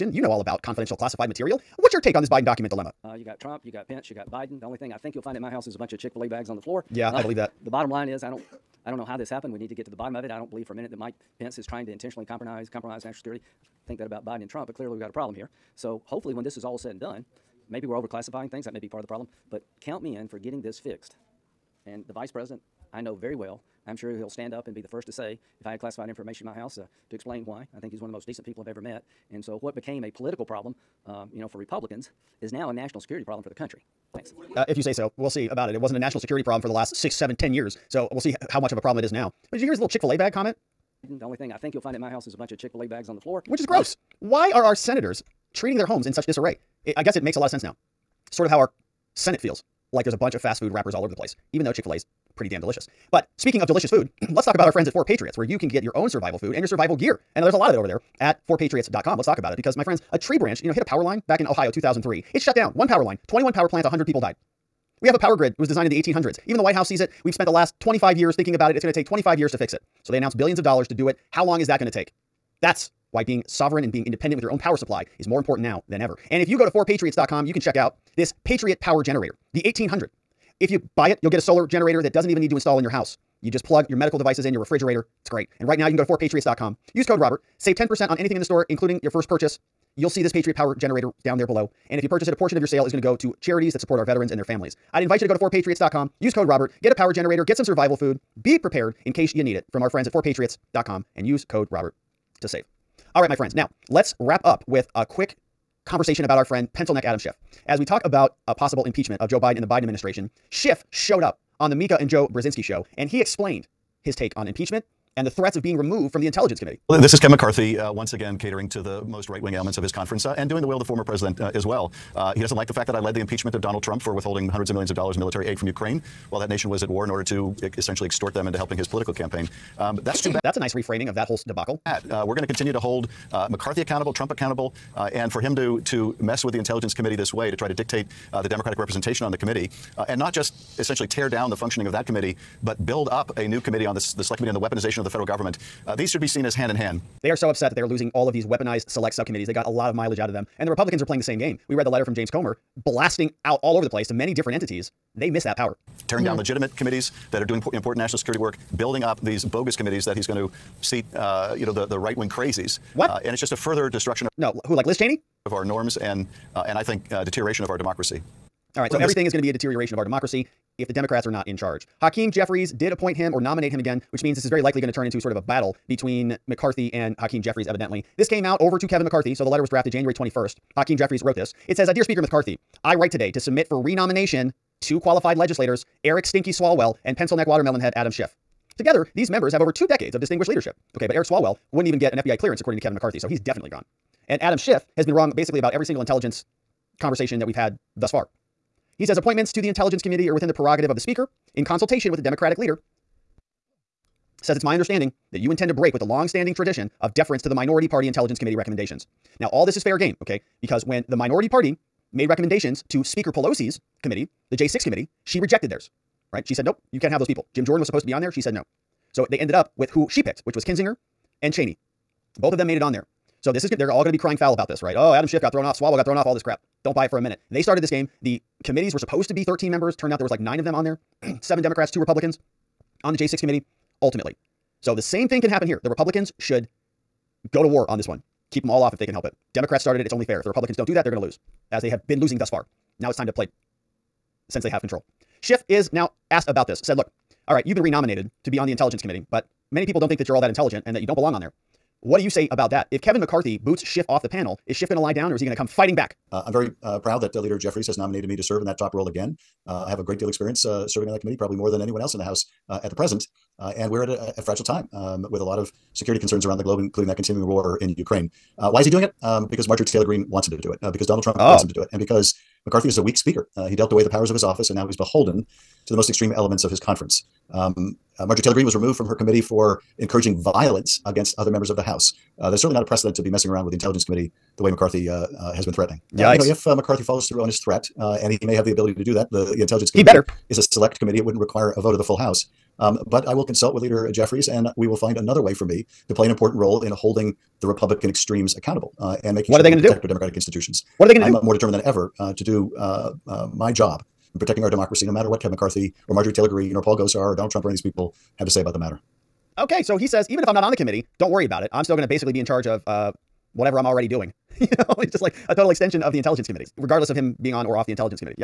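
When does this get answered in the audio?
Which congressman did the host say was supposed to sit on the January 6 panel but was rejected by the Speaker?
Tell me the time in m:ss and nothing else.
3:37.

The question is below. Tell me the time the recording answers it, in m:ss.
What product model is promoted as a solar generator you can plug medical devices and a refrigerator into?
1:18.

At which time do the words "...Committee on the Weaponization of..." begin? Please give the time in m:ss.
2:24.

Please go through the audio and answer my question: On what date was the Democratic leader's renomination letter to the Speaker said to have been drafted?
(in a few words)
January 21.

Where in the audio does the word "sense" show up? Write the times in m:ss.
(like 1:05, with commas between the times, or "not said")
0:47.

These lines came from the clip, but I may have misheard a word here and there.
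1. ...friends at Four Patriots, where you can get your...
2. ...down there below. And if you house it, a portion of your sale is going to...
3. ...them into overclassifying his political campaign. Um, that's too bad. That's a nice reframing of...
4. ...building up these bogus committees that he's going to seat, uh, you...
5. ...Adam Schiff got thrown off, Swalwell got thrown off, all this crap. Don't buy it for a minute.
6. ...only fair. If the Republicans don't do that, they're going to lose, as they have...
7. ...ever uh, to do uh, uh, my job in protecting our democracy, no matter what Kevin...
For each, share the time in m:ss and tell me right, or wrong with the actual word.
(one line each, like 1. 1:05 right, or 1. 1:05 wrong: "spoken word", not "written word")
1. 0:54 right
2. 1:31 wrong: "purchase", not "house"
3. 2:08 wrong: "helping", not "overclassifying"
4. 2:38 right
5. 3:45 right
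6. 4:00 right
7. 5:01 right.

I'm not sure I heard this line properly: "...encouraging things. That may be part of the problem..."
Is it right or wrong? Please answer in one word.
wrong.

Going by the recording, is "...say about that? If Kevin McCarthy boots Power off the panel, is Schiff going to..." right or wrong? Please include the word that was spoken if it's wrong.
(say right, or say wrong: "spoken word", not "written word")
wrong: "Schiff", not "Power".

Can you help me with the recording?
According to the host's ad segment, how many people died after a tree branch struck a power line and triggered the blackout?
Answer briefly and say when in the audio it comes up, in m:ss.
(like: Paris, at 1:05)
100, at 1:03.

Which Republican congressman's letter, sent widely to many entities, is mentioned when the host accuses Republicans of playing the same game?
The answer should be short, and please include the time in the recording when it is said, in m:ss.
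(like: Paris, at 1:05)
James Comer, at 2:32.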